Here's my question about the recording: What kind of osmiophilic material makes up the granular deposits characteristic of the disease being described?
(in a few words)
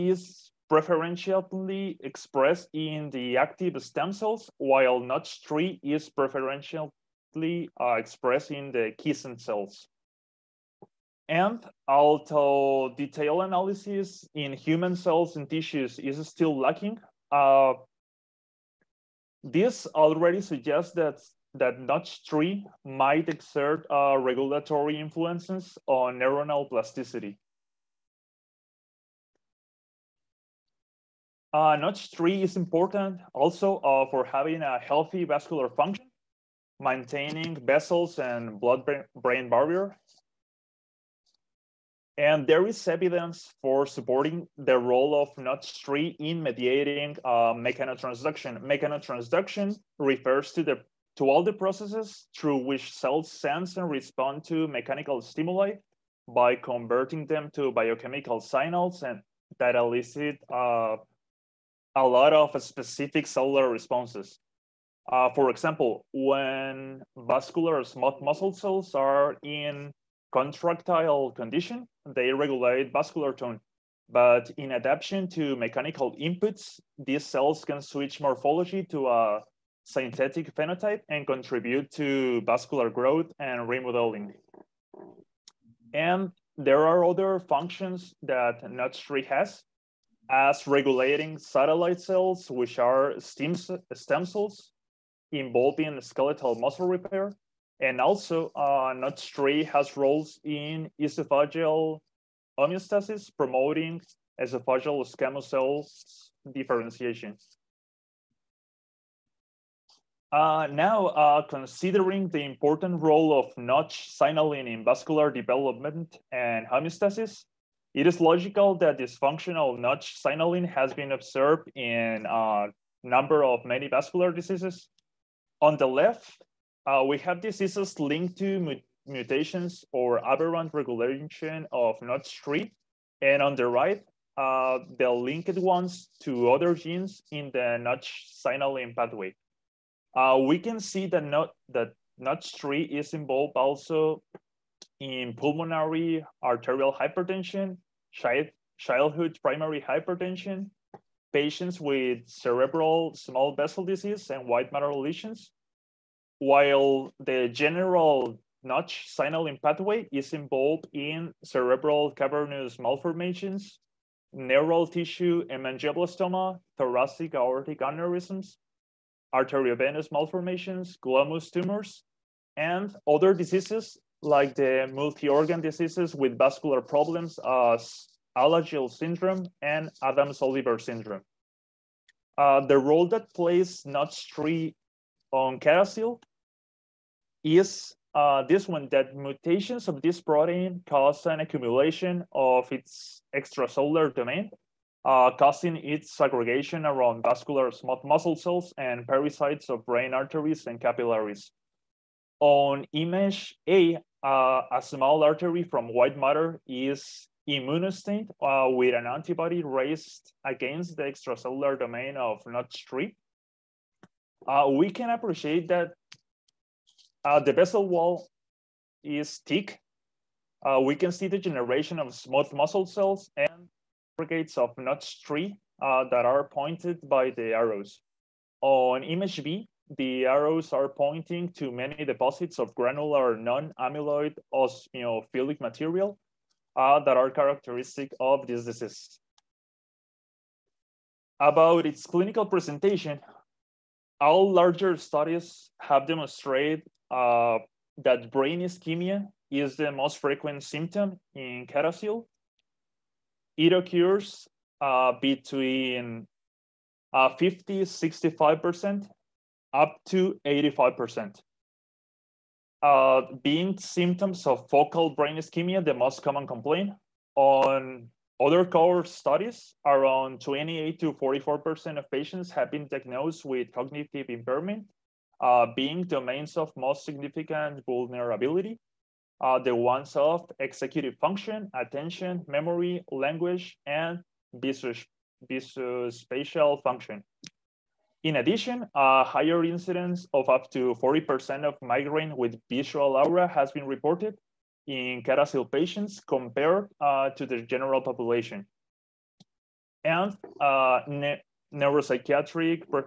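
Non-amyloid.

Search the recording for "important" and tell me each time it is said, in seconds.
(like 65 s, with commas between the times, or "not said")
32 s, 112 s.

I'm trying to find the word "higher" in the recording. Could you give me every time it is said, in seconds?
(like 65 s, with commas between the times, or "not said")
289 s.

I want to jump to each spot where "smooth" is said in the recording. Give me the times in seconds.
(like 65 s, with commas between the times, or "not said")
67 s, 197 s, 222 s.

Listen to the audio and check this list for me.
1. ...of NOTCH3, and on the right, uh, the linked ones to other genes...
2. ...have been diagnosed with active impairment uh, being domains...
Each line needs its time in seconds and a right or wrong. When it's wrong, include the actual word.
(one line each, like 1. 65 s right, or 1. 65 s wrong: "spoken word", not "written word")
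1. 131 s right
2. 272 s wrong: "cognitive", not "active".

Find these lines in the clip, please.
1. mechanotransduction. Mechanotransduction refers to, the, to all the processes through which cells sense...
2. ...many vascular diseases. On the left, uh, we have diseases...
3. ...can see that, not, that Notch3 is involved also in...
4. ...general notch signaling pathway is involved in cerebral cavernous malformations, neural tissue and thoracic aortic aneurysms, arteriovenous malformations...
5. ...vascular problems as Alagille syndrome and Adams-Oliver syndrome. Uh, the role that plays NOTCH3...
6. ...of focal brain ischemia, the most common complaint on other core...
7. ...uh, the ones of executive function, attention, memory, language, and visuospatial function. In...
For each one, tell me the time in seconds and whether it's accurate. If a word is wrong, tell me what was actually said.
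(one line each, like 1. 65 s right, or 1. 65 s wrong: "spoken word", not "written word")
1. 48 s right
2. 123 s right
3. 140 s right
4. 157 s right
5. 176 s right
6. 264 s right
7. 279 s right.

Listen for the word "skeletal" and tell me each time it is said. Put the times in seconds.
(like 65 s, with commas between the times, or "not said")
96 s.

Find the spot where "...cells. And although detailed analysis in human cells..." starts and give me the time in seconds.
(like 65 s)
9 s.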